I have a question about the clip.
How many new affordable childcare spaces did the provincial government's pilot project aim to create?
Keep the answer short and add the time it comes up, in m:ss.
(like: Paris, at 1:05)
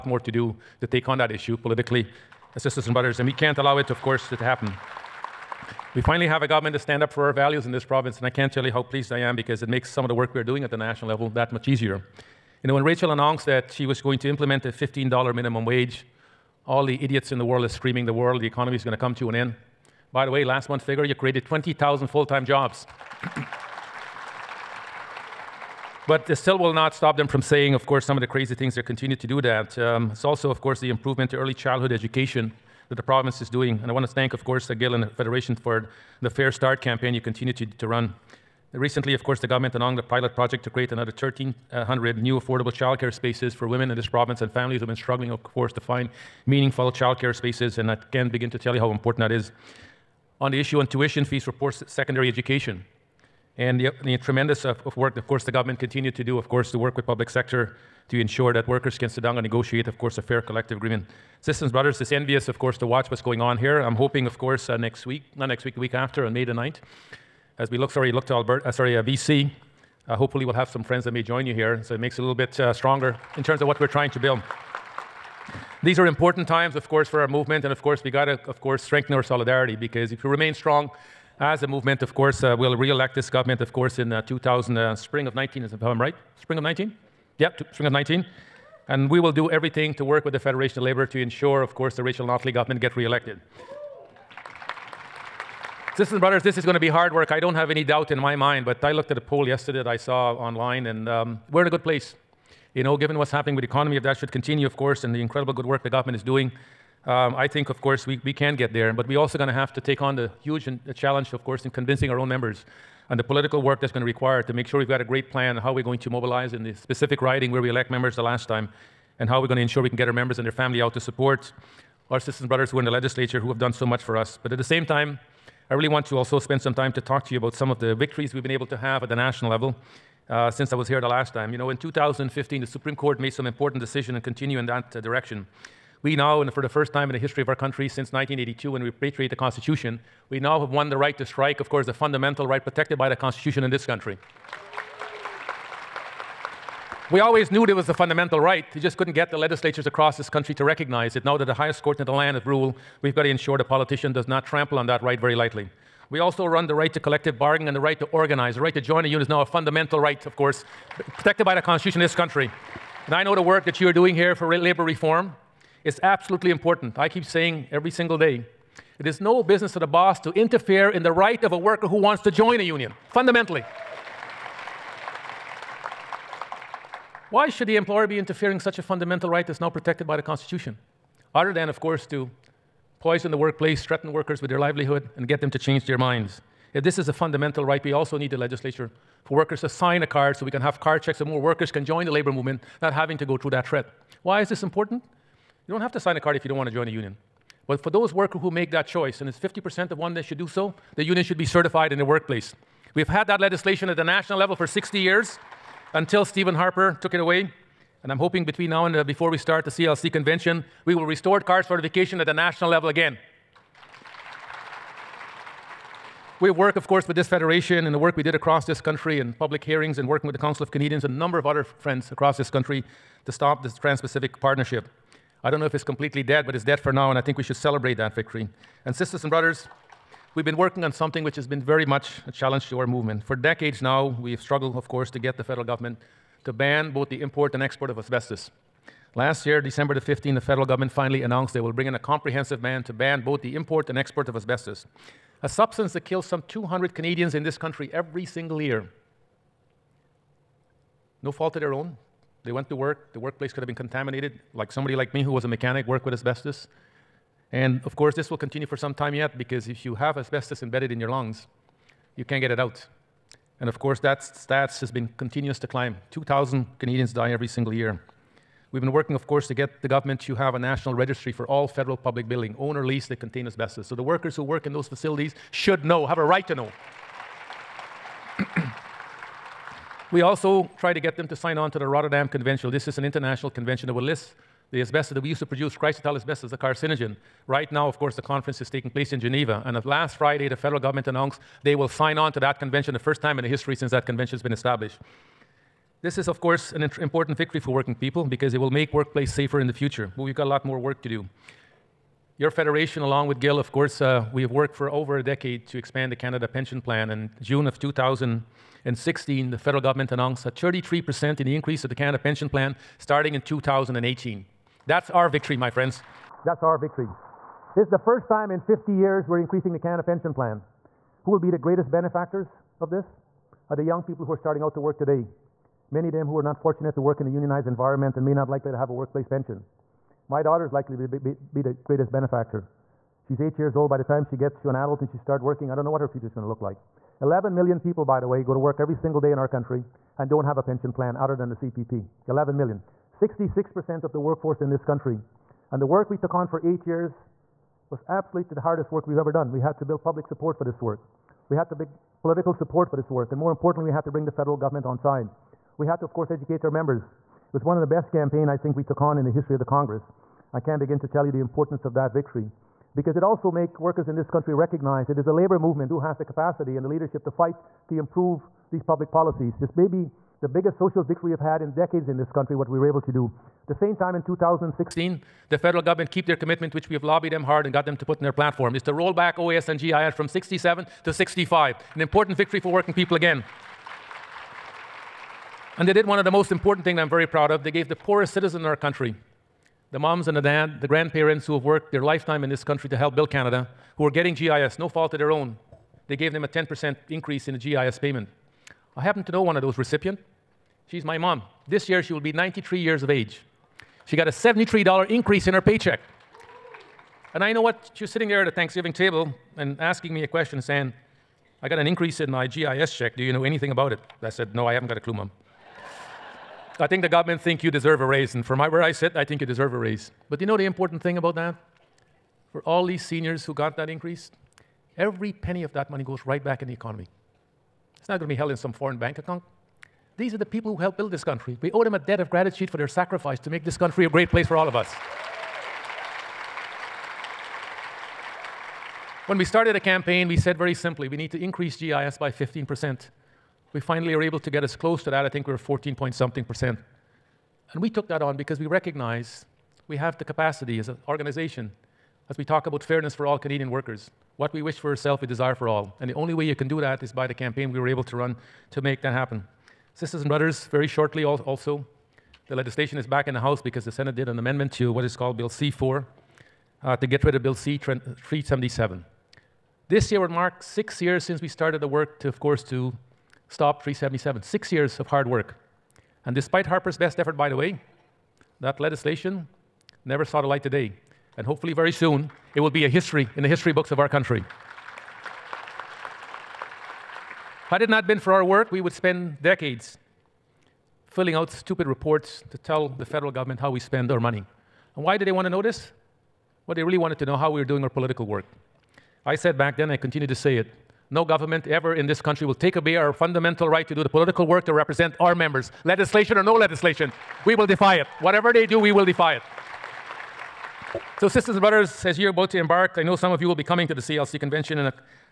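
1,300, at 0:41.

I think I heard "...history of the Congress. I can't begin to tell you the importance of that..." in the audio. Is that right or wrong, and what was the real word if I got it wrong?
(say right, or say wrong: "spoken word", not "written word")
right.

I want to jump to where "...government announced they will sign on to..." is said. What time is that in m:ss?
4:50.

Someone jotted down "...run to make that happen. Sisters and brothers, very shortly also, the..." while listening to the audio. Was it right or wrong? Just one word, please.
right.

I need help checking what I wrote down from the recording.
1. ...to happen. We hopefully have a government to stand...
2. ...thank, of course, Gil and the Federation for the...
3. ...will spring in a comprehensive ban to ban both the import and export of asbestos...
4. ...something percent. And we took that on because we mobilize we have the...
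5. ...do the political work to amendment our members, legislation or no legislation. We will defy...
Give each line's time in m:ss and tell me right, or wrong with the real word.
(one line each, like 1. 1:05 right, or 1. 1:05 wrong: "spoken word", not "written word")
1. 0:04 wrong: "finally", not "hopefully"
2. 0:34 right
3. 4:01 wrong: "bring", not "spring"
4. 7:26 wrong: "recognize", not "mobilize"
5. 8:23 wrong: "represent", not "amendment".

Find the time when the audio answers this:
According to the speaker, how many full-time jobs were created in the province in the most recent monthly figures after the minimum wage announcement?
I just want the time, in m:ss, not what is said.
0:21.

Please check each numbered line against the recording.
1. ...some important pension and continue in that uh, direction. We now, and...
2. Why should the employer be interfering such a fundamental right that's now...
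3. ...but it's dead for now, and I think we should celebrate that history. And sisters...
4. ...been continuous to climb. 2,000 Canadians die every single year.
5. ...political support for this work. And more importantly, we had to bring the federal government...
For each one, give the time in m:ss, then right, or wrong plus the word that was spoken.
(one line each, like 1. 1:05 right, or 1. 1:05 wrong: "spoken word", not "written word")
1. 2:13 wrong: "decision", not "pension"
2. 2:57 right
3. 3:46 wrong: "victory", not "history"
4. 4:24 right
5. 5:52 right.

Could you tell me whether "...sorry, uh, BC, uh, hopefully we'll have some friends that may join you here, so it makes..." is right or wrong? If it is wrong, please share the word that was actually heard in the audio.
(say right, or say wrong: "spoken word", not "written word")
right.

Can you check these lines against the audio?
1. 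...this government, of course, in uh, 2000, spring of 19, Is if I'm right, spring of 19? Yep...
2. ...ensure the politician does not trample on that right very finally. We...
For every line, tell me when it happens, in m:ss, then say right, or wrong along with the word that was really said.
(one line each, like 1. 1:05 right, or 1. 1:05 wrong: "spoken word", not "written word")
1. 1:23 right
2. 2:33 wrong: "lightly", not "finally".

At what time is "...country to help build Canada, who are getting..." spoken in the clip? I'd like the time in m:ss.
6:32.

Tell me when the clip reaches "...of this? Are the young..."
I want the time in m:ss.
5:22.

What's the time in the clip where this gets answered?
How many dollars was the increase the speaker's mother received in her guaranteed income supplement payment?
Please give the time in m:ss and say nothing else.
6:44.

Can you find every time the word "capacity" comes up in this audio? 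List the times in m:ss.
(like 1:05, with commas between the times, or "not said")
6:06, 7:30.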